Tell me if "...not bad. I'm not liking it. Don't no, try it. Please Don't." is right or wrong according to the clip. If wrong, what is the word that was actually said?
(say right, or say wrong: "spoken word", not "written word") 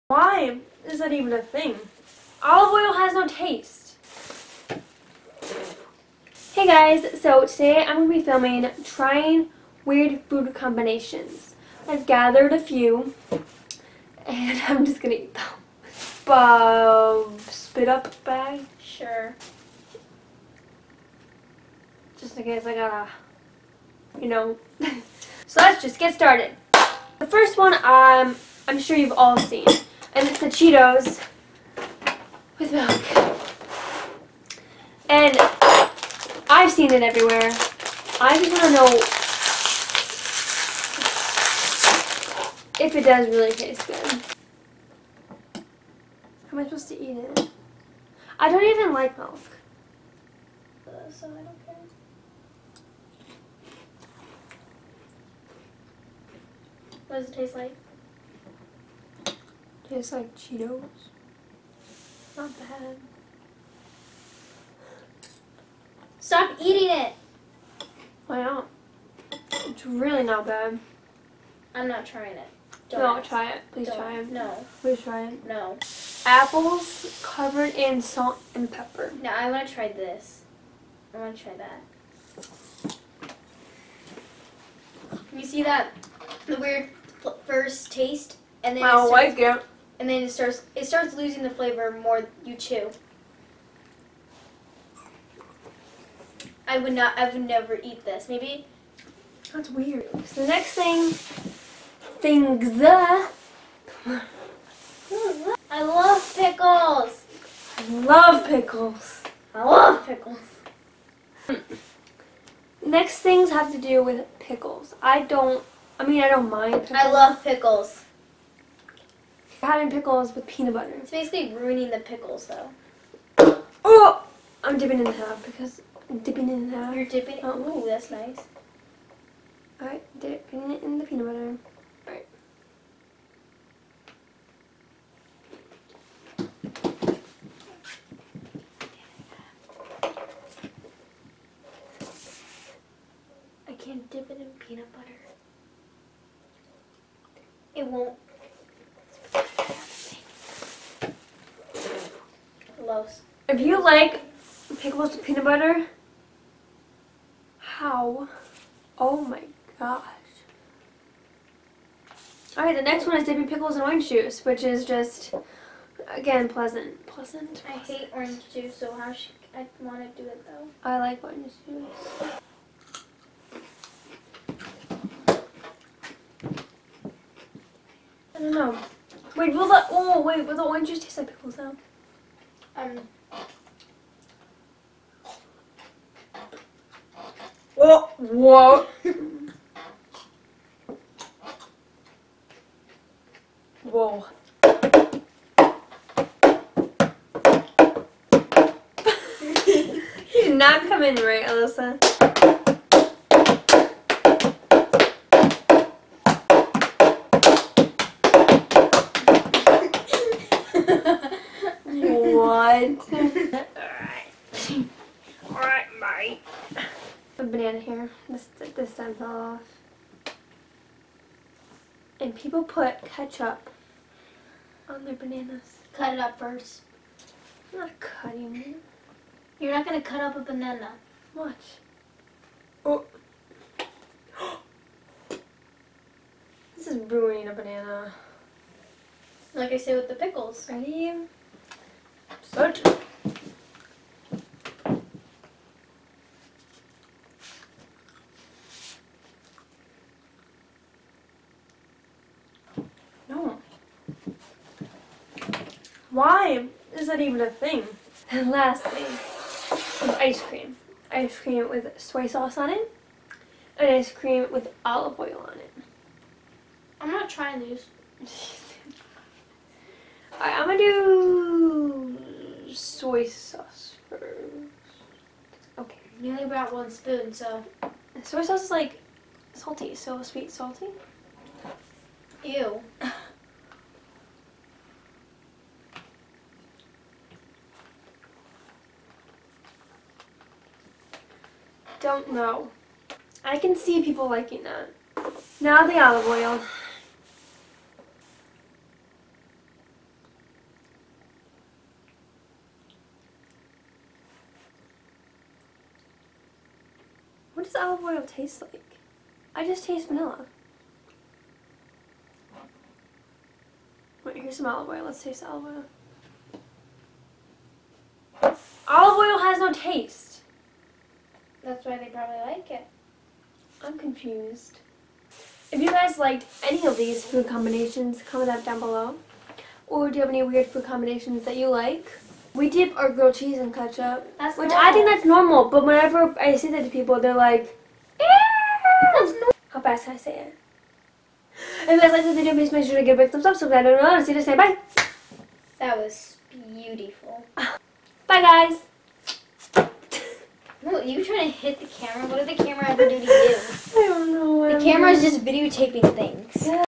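wrong: "trying", not "liking".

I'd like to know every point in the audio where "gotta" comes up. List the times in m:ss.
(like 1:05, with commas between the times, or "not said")
0:22.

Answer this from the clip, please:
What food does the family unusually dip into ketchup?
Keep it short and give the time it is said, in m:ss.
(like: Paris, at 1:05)
Grilled cheese, at 5:33.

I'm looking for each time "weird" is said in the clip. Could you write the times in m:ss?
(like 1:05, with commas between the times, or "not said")
0:09, 1:26, 1:39, 5:30.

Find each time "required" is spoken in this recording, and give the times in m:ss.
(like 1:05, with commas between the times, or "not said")
not said.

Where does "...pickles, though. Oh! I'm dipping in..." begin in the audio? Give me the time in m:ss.
2:01.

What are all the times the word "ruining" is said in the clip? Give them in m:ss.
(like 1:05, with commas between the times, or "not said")
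2:01, 3:57.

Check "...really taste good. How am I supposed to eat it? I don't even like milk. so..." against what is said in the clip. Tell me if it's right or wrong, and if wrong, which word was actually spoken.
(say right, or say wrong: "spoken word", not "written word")
right.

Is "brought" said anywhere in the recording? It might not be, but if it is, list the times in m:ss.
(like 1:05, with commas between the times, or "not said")
4:36.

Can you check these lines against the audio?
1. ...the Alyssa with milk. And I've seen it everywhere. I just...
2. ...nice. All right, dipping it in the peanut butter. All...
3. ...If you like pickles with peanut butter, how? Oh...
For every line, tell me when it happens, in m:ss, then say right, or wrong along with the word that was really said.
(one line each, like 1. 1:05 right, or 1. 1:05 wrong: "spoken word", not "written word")
1. 0:30 wrong: "Cheetos", not "Alyssa"
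2. 2:08 right
3. 2:33 right.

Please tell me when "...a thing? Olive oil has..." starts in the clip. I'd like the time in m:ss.
0:01.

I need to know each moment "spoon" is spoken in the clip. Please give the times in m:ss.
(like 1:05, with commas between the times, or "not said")
4:36.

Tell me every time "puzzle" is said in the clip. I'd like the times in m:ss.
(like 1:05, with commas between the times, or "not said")
not said.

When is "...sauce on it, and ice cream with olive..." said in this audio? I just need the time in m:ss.
4:22.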